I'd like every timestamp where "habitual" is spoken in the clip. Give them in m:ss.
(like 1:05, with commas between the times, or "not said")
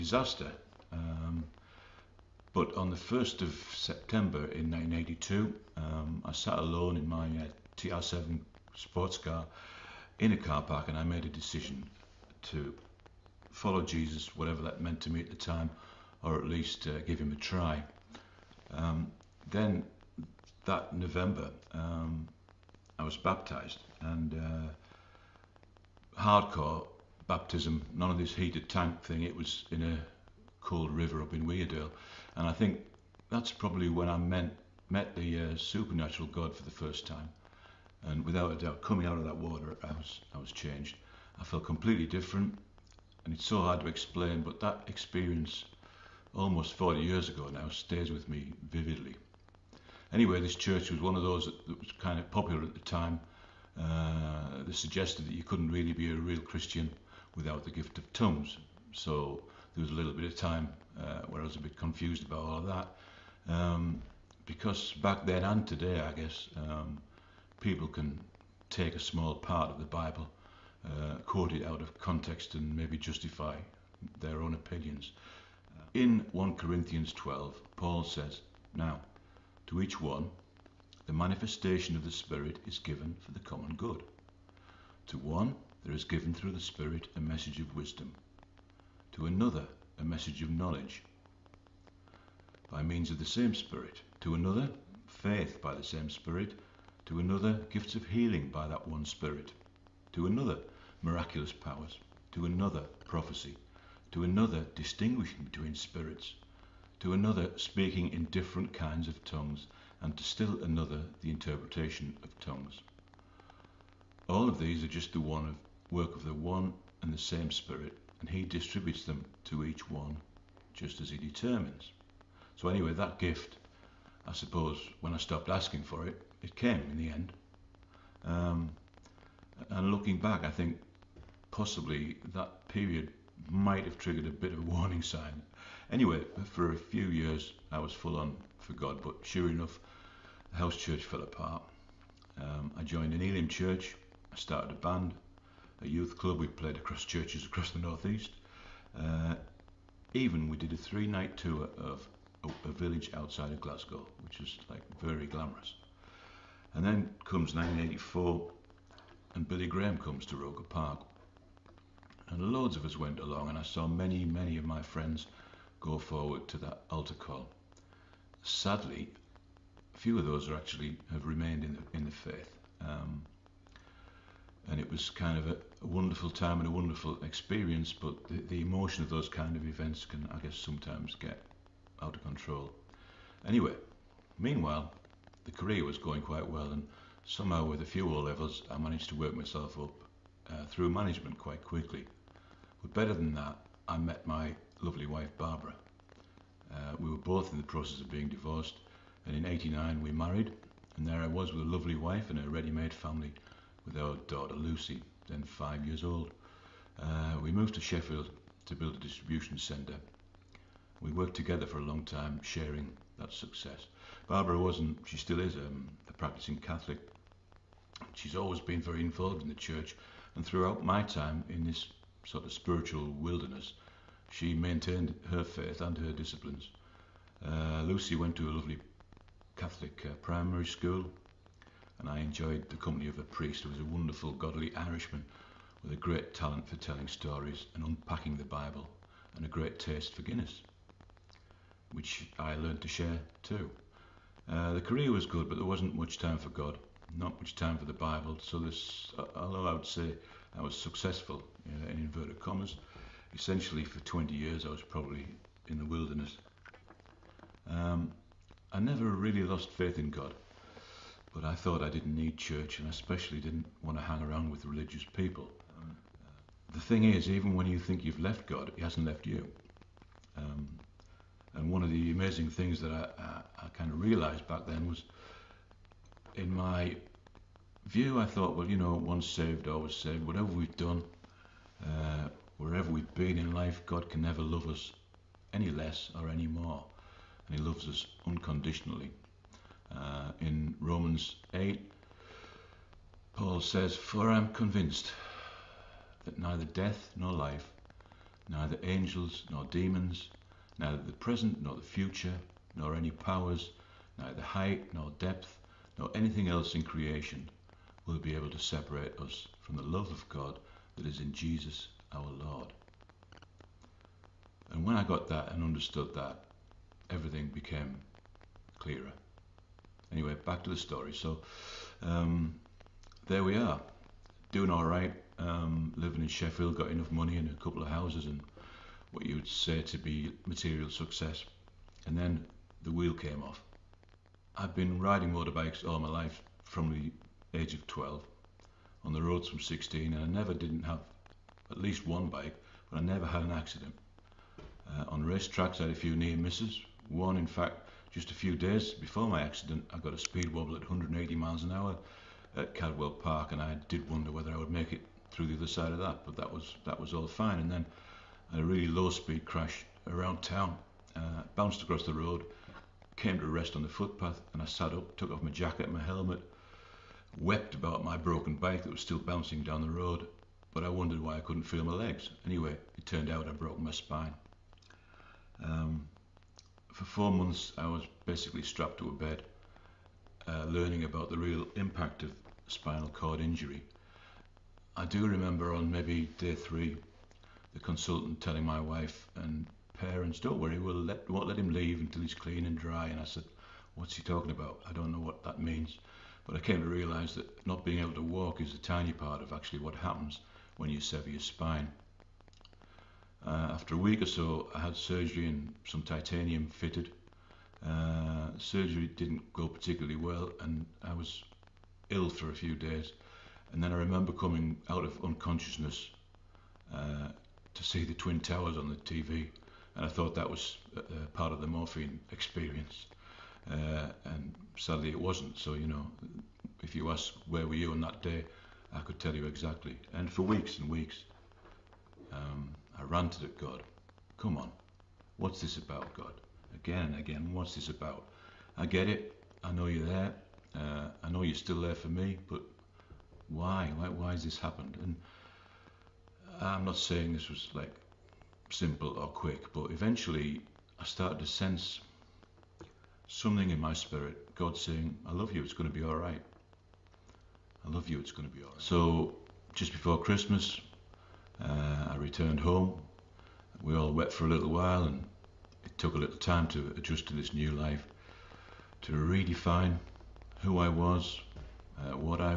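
not said.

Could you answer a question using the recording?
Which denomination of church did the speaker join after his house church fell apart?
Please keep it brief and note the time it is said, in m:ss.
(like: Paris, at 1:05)
Elim, at 2:23.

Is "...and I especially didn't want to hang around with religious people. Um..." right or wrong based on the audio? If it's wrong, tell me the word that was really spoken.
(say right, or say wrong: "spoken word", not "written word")
right.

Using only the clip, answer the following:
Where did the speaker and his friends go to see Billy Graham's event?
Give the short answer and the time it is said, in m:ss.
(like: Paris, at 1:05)
Roker Park, at 2:40.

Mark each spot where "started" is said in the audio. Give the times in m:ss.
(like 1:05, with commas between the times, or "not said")
2:24, 7:31.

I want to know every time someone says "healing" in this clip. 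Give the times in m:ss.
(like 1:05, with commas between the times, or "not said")
1:38.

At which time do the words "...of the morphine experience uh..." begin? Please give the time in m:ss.
7:01.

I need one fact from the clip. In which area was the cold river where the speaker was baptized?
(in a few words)
Weardale.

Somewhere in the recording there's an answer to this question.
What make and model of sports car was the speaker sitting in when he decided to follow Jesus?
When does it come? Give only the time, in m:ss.
0:07.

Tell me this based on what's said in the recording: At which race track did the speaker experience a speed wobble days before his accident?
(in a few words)
Cadwell Park.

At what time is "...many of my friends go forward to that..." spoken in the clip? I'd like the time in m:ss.
2:44.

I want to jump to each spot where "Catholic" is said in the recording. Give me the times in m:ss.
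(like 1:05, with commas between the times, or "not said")
3:36, 3:49.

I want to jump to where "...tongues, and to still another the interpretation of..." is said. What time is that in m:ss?
1:49.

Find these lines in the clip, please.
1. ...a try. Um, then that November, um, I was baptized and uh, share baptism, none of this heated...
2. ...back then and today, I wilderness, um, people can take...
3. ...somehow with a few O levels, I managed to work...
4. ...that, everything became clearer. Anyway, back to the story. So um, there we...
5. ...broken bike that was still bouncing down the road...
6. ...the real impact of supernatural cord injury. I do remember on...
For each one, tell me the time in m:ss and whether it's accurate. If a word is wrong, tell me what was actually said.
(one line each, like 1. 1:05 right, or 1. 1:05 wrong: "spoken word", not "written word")
1. 0:17 wrong: "hardcore", not "share"
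2. 1:04 wrong: "guess", not "wilderness"
3. 3:07 right
4. 5:16 right
5. 6:08 right
6. 6:21 wrong: "spinal", not "supernatural".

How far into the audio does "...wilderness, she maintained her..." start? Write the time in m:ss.
3:43.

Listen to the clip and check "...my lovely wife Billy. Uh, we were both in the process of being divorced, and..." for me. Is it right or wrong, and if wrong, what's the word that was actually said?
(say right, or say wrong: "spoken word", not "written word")
wrong: "Barbara", not "Billy".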